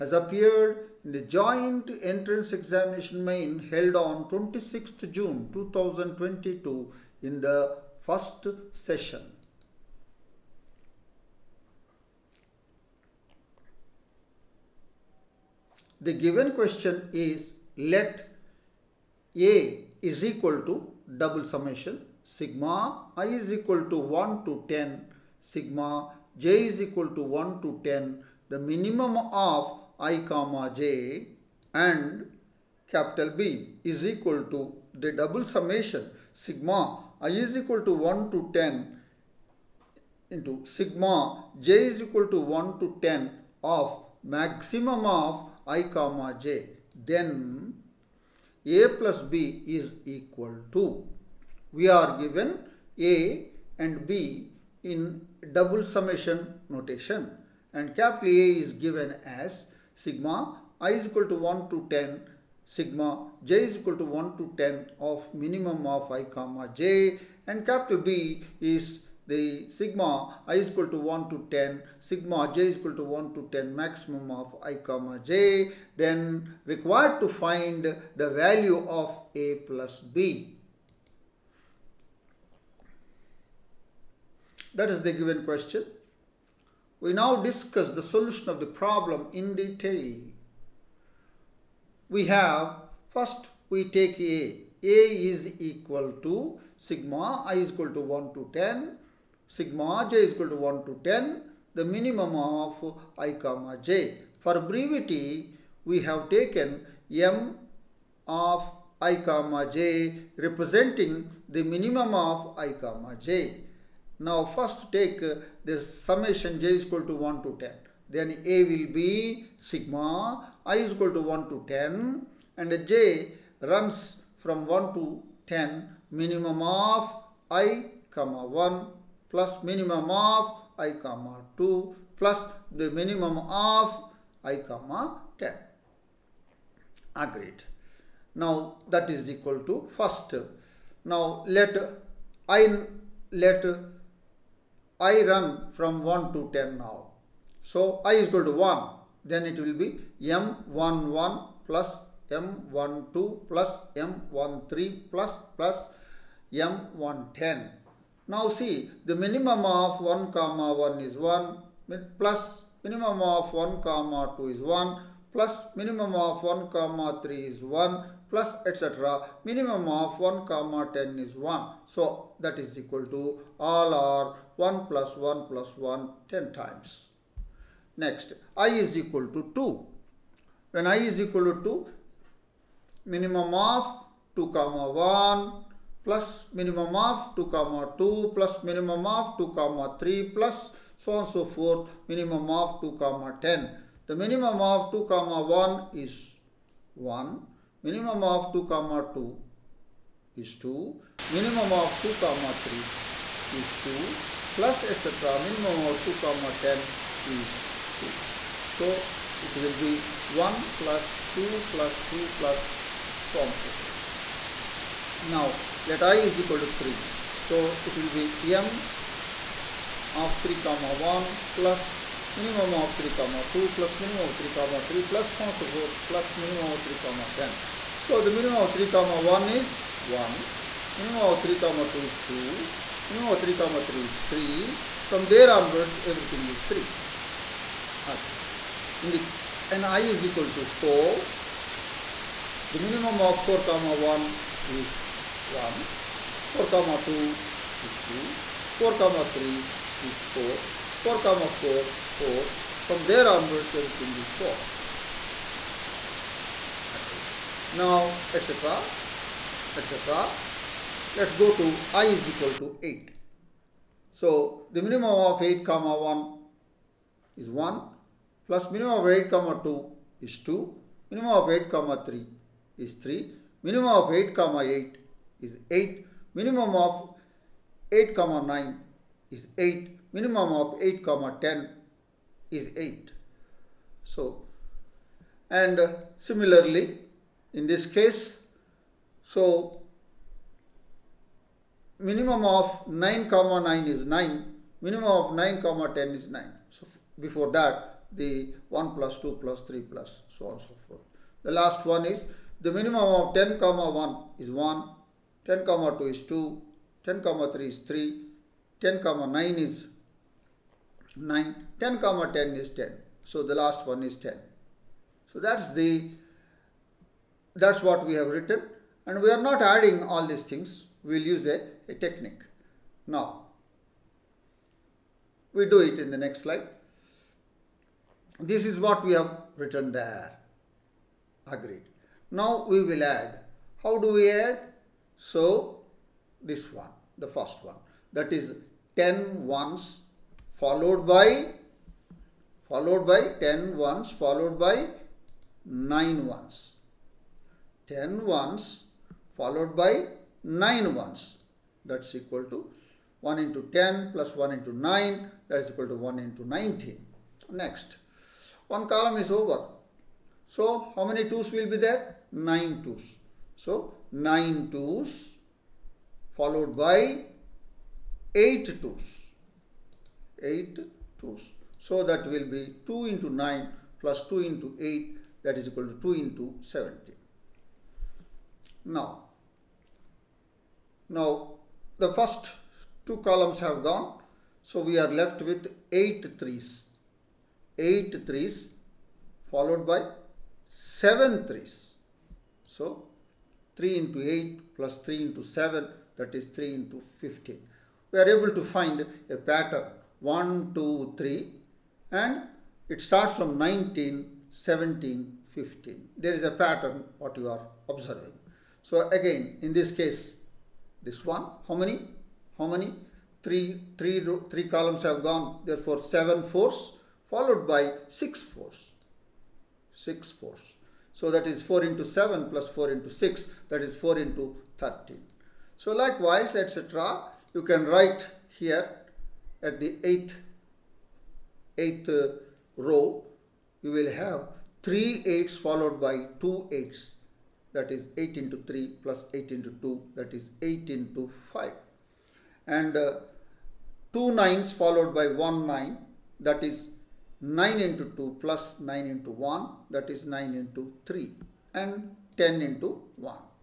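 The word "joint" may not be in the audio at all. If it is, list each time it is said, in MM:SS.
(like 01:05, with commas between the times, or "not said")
00:01.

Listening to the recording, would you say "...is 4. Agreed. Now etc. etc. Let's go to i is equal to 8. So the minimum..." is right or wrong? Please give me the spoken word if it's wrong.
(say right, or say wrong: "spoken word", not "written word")
right.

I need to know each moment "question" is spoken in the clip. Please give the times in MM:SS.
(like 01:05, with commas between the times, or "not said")
00:16, 01:25.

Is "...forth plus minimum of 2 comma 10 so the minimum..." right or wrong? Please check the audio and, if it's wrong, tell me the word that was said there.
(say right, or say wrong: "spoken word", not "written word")
wrong: "3", not "2".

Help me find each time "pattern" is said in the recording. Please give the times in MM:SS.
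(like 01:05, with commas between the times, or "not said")
06:39, 06:46.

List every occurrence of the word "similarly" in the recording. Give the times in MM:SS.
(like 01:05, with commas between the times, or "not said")
04:46.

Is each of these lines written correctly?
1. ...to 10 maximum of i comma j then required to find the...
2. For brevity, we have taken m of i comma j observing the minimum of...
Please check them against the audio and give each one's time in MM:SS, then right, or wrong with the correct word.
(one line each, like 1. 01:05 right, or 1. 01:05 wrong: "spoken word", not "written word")
1. 01:13 right
2. 01:44 wrong: "representing", not "observing".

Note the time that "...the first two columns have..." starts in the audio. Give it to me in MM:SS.
06:22.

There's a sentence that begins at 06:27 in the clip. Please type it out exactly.
8 threes followed by 7 threes.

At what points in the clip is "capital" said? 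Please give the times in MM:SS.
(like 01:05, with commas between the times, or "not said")
00:32, 00:57, 01:07.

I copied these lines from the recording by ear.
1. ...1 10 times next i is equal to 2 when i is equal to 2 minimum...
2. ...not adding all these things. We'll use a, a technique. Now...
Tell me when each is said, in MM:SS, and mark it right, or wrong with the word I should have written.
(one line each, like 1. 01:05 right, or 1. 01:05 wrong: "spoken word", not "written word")
1. 02:55 right
2. 05:19 right.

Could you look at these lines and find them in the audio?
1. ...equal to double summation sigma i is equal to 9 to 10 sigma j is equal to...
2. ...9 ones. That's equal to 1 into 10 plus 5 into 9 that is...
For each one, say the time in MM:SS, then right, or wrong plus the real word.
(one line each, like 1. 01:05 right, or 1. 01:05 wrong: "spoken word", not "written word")
1. 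00:20 wrong: "1", not "9"
2. 05:50 wrong: "1", not "5".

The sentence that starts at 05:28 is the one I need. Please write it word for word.
This is what we have written there.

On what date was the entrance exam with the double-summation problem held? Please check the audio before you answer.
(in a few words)
26th June 2022.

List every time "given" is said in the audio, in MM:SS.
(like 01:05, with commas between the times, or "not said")
00:16, 00:52, 00:58, 01:25.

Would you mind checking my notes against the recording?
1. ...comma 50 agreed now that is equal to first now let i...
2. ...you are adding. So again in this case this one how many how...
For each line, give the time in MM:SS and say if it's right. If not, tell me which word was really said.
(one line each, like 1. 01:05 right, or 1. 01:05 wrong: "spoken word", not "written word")
1. 02:14 wrong: "10", not "50"
2. 06:47 wrong: "observing", not "adding".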